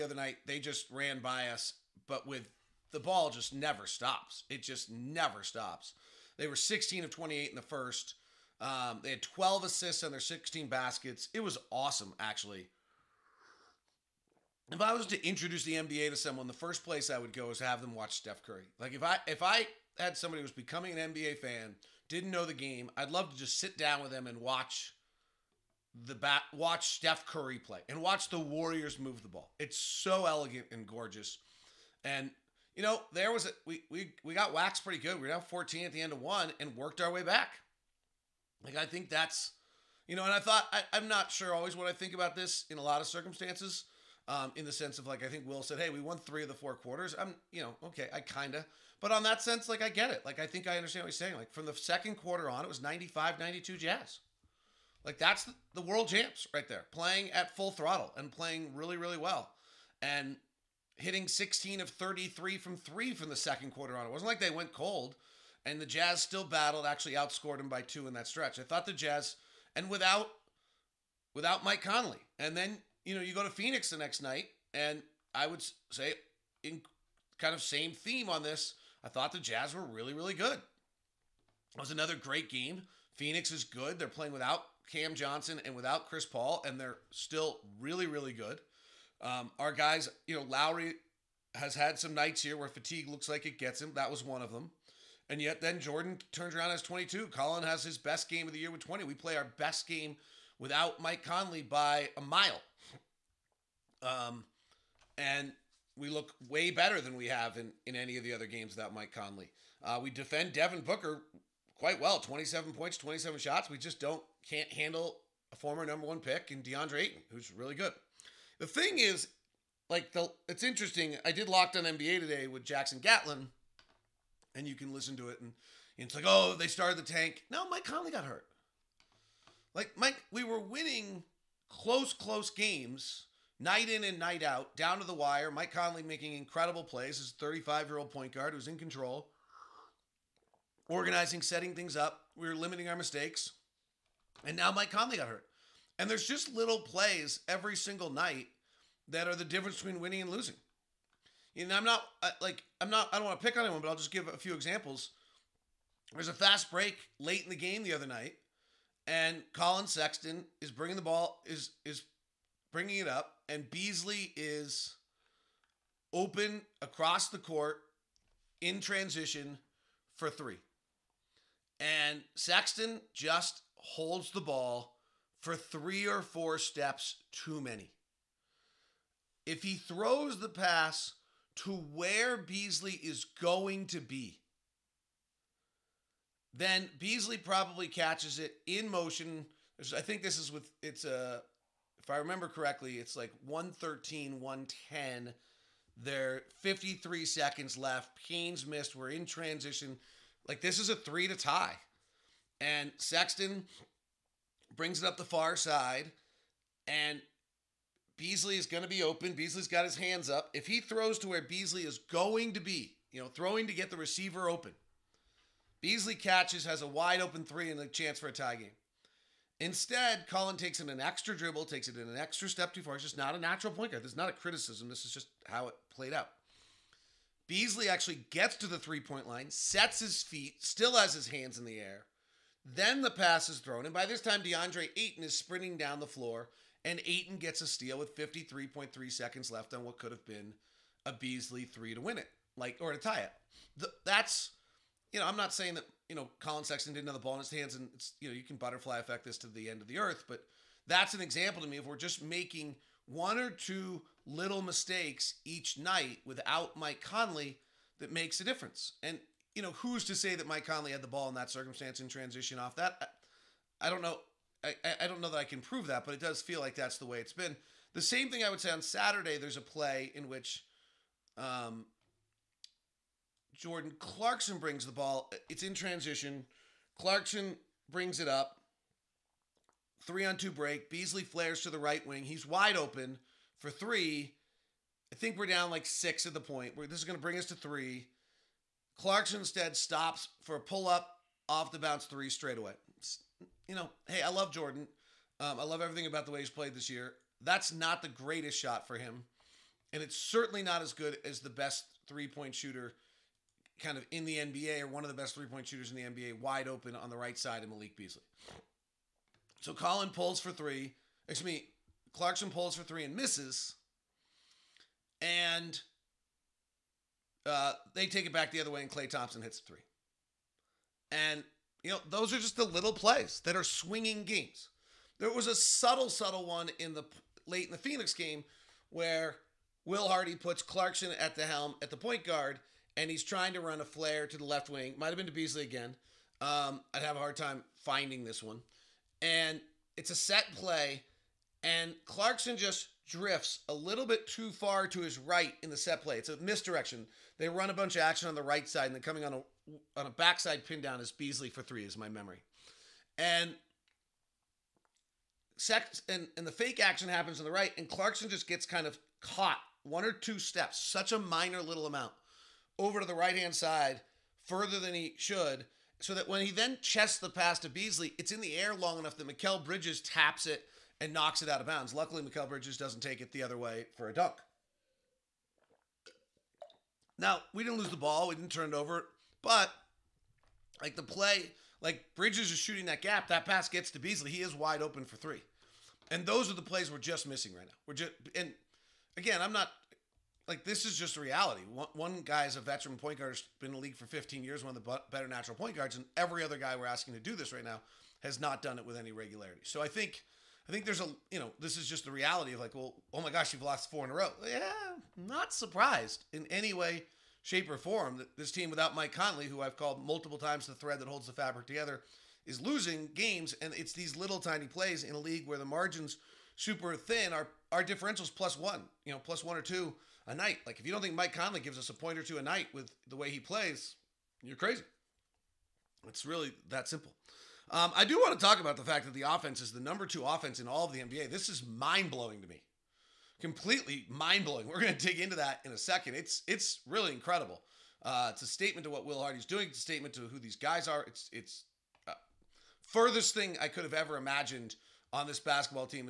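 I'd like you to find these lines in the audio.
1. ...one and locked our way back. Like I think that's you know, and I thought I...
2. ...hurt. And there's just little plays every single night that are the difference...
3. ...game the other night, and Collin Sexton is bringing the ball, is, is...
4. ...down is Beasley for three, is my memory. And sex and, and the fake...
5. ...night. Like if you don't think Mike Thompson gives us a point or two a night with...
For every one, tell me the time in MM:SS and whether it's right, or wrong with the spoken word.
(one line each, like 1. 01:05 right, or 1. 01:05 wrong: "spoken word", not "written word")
1. 00:36 wrong: "worked", not "locked"
2. 02:25 right
3. 02:37 right
4. 05:50 right
5. 07:00 wrong: "Conley", not "Thompson".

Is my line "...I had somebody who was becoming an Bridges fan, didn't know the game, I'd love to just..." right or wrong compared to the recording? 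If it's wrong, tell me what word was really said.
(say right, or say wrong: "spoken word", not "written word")
wrong: "NBA", not "Bridges".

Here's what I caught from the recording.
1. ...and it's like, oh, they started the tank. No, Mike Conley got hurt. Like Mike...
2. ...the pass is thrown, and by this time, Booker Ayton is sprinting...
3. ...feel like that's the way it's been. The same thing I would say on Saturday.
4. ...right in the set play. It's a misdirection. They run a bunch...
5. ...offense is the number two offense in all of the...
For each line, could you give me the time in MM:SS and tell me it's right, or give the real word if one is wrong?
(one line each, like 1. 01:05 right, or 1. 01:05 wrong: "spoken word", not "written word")
1. 02:05 right
2. 03:53 wrong: "DeAndre", not "Booker"
3. 04:26 right
4. 05:45 right
5. 07:09 right.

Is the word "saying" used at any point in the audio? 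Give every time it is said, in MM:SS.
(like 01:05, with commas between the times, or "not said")
00:51, 04:05.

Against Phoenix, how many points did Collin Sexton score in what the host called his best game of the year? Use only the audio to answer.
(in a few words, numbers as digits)
20.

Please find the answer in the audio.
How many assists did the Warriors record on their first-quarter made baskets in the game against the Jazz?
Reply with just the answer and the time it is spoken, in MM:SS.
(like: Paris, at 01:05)
12, at 00:09.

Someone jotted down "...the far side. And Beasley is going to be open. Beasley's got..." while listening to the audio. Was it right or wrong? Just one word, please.
right.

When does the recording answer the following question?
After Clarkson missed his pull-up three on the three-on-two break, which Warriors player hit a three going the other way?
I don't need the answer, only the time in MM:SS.
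05:18.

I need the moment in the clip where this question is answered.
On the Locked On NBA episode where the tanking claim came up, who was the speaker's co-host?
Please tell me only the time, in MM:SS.
02:02.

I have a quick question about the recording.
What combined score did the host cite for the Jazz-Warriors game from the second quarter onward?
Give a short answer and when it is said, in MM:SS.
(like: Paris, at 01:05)
95-92 Jazz, at 00:52.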